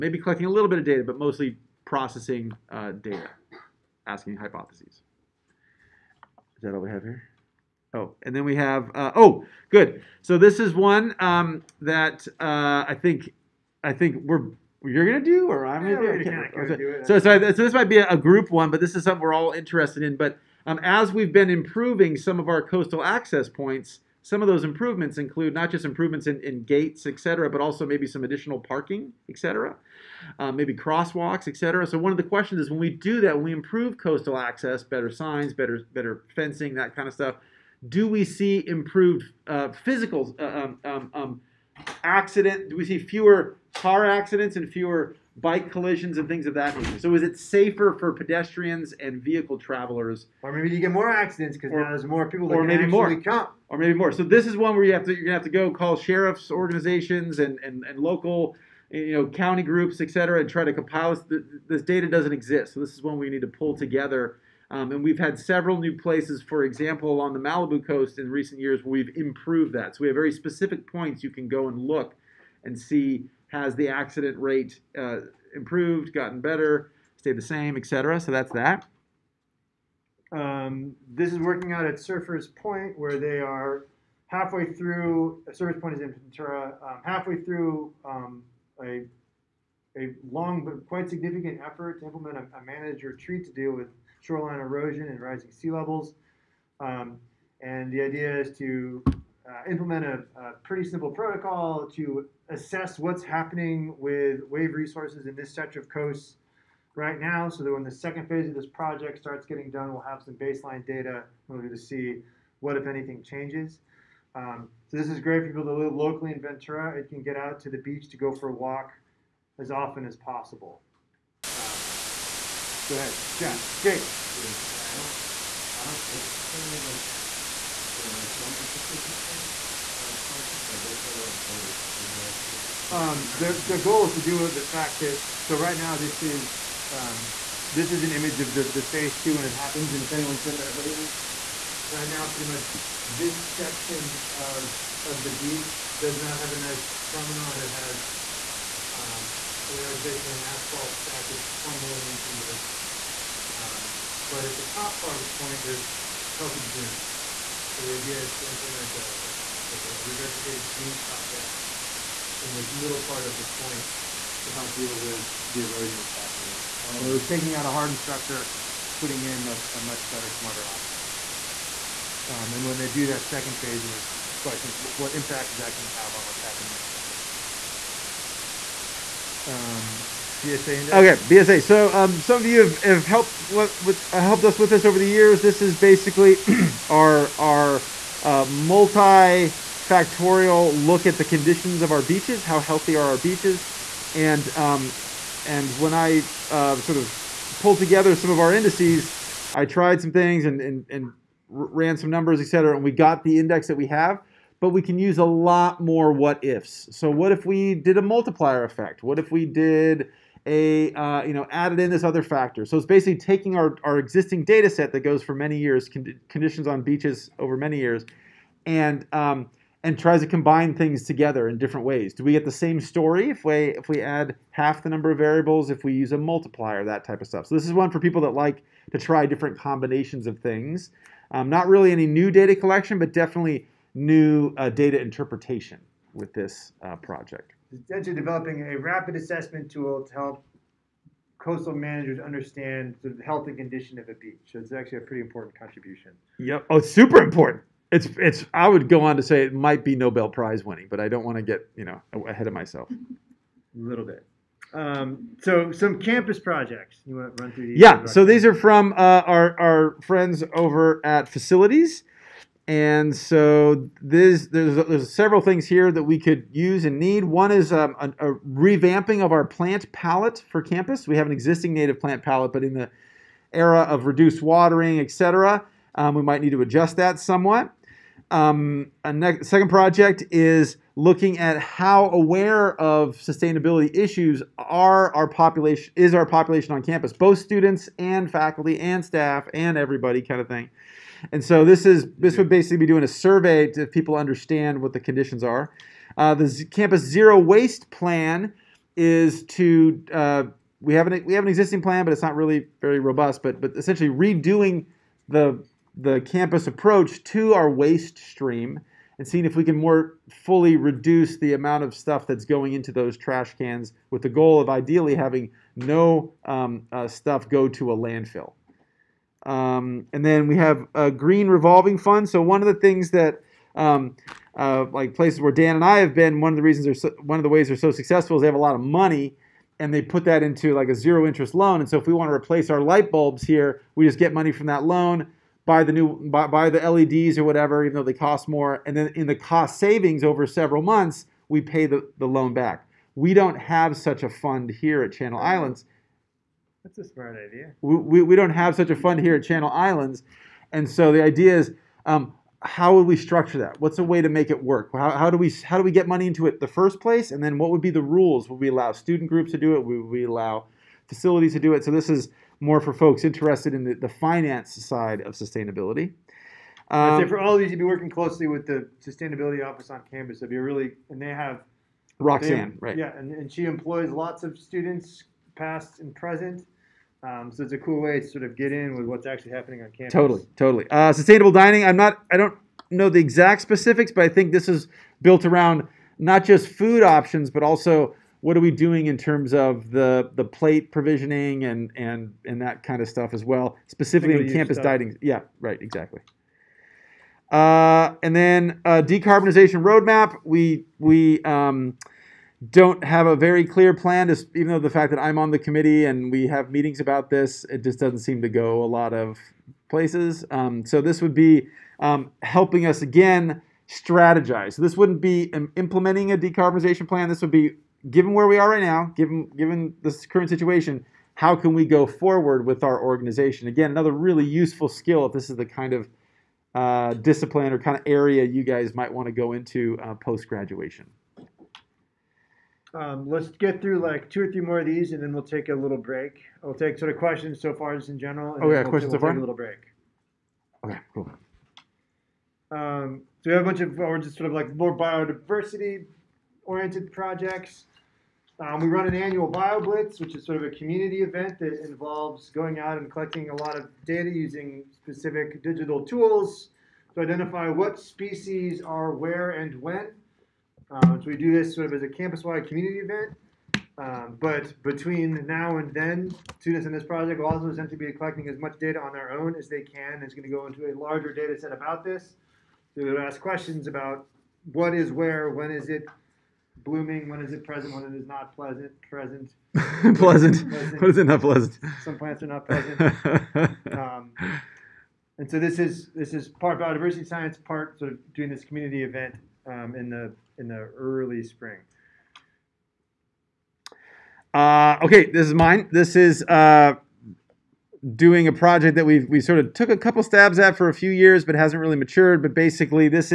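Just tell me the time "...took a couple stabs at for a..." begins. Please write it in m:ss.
8:19.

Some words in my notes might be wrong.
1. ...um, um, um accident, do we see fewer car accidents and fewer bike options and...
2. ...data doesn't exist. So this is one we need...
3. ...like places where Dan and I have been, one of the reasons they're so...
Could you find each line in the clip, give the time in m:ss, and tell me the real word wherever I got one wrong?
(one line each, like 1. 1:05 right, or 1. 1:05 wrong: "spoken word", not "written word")
1. 0:40 wrong: "collisions", not "options"
2. 1:01 right
3. 5:24 right.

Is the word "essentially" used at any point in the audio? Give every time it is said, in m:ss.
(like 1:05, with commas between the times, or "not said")
3:57, 5:03, 7:47.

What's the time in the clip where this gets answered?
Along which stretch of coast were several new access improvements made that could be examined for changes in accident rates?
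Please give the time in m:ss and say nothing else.
1:07.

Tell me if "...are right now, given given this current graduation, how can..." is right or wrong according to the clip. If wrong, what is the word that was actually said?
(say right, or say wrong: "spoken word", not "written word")
wrong: "situation", not "graduation".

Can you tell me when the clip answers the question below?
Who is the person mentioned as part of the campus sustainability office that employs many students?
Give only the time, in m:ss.
6:12.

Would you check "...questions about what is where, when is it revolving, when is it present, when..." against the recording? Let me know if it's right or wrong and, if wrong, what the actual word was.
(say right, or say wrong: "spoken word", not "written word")
wrong: "blooming", not "revolving".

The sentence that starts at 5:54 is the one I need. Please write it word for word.
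How, how, do we, how do we get money into it the first place?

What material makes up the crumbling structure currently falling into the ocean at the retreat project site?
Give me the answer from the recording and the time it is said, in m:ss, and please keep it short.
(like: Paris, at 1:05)
asphalt, at 2:30.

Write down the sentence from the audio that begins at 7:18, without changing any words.
And oh yeah, we'll questions so far.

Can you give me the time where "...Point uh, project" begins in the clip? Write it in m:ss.
2:09.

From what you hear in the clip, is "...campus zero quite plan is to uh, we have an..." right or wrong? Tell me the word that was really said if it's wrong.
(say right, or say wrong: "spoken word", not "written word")
wrong: "waste", not "quite".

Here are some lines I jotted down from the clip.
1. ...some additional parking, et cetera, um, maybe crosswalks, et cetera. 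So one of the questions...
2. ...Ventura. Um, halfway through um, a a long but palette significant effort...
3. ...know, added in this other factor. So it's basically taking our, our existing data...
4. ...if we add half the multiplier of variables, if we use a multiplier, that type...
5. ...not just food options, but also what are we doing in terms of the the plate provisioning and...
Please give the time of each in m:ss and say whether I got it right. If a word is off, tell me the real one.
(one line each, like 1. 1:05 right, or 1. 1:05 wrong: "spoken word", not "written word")
1. 0:28 right
2. 1:26 wrong: "quite", not "palette"
3. 3:31 right
4. 3:43 wrong: "number", not "multiplier"
5. 6:26 right.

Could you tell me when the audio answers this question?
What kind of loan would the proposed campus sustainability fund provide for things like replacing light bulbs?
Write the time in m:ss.
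5:30.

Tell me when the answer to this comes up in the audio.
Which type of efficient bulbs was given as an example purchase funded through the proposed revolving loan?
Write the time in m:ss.
5:36.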